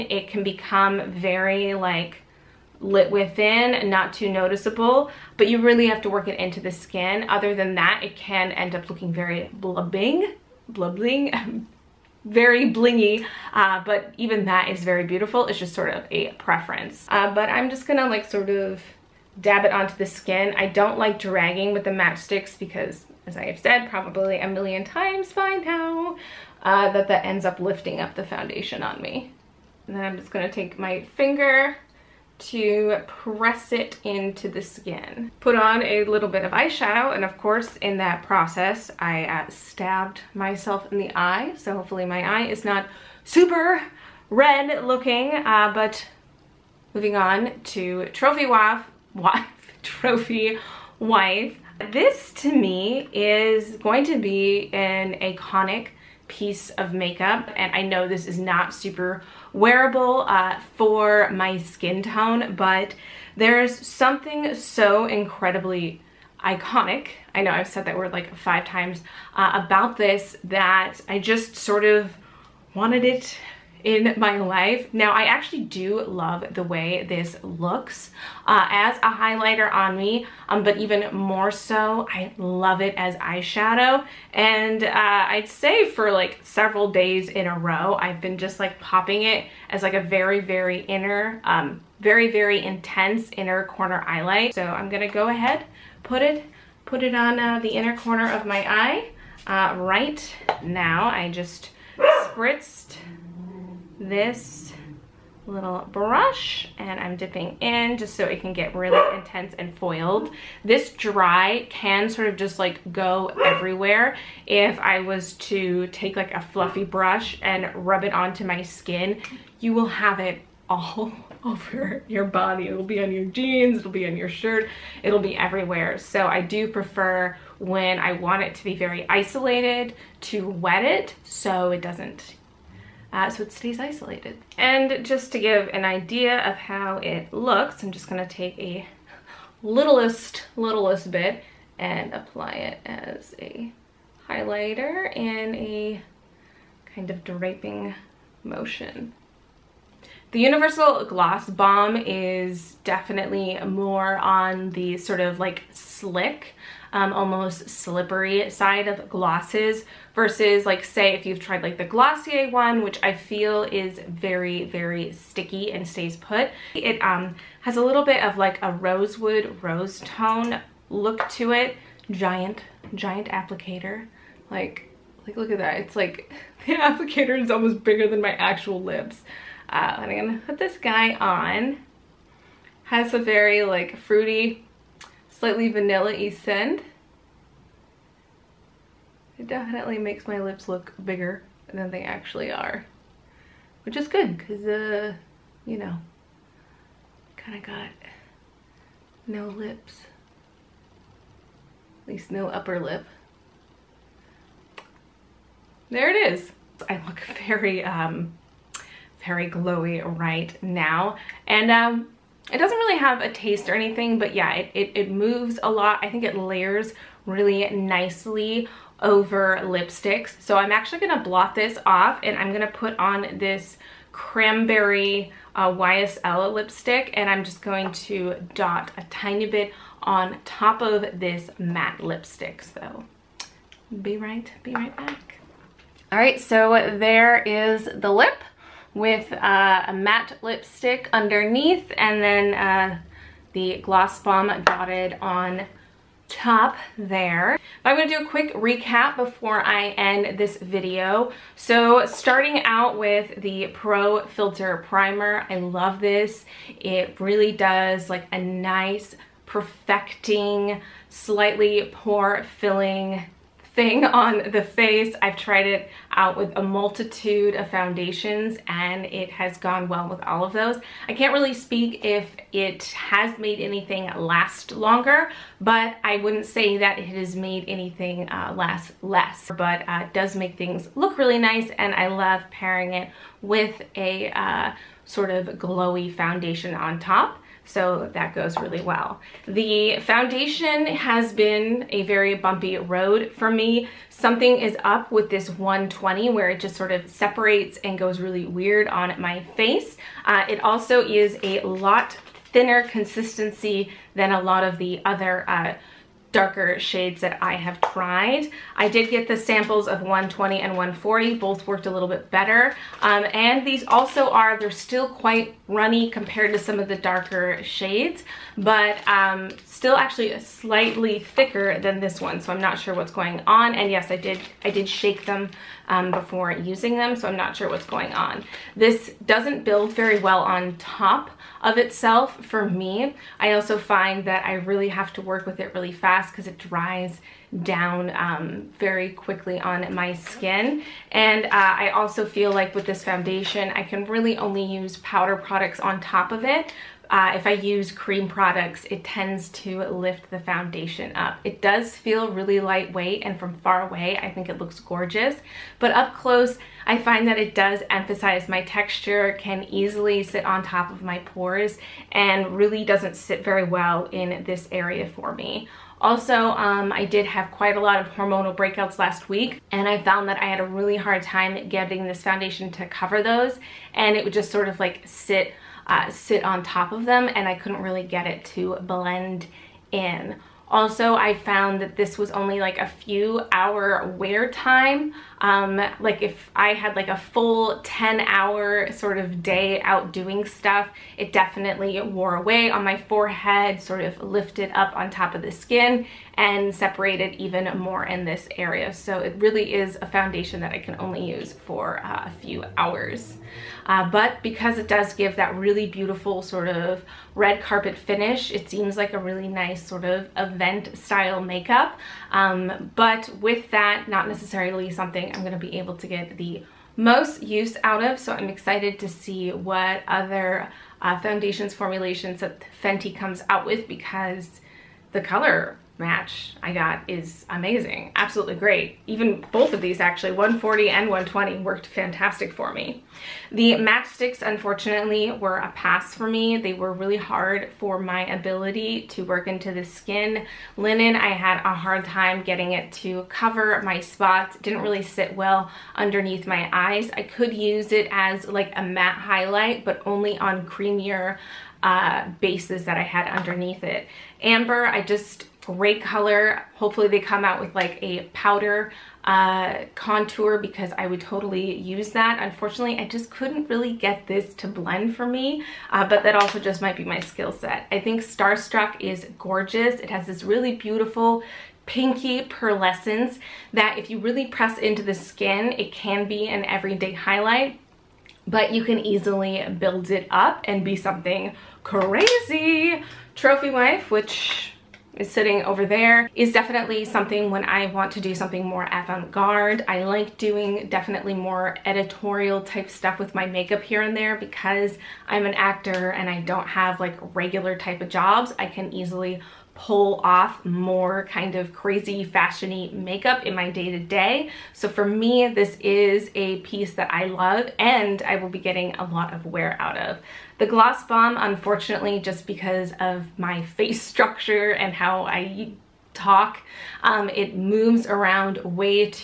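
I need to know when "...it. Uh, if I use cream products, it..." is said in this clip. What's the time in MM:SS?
05:46.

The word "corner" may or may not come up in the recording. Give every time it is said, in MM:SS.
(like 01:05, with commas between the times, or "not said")
01:33, 01:37.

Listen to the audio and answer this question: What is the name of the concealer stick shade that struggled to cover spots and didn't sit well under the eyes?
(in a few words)
Linen.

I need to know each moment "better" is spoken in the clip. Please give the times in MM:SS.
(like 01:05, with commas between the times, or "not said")
05:12.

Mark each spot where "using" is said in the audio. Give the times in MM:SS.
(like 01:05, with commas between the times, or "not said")
05:26.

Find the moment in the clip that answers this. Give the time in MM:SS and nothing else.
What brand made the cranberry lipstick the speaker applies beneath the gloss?
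03:45.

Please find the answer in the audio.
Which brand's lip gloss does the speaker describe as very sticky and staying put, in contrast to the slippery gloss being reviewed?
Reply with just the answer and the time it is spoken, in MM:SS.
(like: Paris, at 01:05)
Glossier, at 02:41.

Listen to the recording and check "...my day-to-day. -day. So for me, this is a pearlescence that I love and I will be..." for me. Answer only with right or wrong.
wrong.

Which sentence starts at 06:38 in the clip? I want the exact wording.
So it really is a foundation that I can only use for uh, a few hours.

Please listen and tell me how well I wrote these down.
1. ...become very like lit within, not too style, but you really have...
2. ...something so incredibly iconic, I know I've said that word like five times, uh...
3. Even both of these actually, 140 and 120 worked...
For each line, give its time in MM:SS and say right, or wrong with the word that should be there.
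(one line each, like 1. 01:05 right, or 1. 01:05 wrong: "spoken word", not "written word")
1. 00:00 wrong: "noticeable", not "style"
2. 01:03 right
3. 07:09 right.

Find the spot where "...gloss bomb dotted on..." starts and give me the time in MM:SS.
04:03.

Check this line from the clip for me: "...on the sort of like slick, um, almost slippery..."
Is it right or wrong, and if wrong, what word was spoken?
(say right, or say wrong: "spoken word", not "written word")
right.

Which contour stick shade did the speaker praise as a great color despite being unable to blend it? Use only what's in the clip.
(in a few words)
Amber.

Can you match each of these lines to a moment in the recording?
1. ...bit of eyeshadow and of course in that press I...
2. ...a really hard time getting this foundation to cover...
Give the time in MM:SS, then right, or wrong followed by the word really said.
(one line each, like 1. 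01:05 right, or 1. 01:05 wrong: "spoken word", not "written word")
1. 00:36 wrong: "process", not "press"
2. 06:10 right.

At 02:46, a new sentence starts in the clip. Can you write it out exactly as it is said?
It um, has a little bit of like a rosewood rose tone look to it.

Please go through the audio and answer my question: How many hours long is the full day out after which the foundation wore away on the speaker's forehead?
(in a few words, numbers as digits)
10.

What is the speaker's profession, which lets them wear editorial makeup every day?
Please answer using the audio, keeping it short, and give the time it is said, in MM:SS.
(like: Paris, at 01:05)
actor, at 08:15.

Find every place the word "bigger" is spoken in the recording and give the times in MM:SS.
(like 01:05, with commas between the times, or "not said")
02:57, 03:11.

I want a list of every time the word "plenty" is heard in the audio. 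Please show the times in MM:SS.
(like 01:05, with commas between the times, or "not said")
not said.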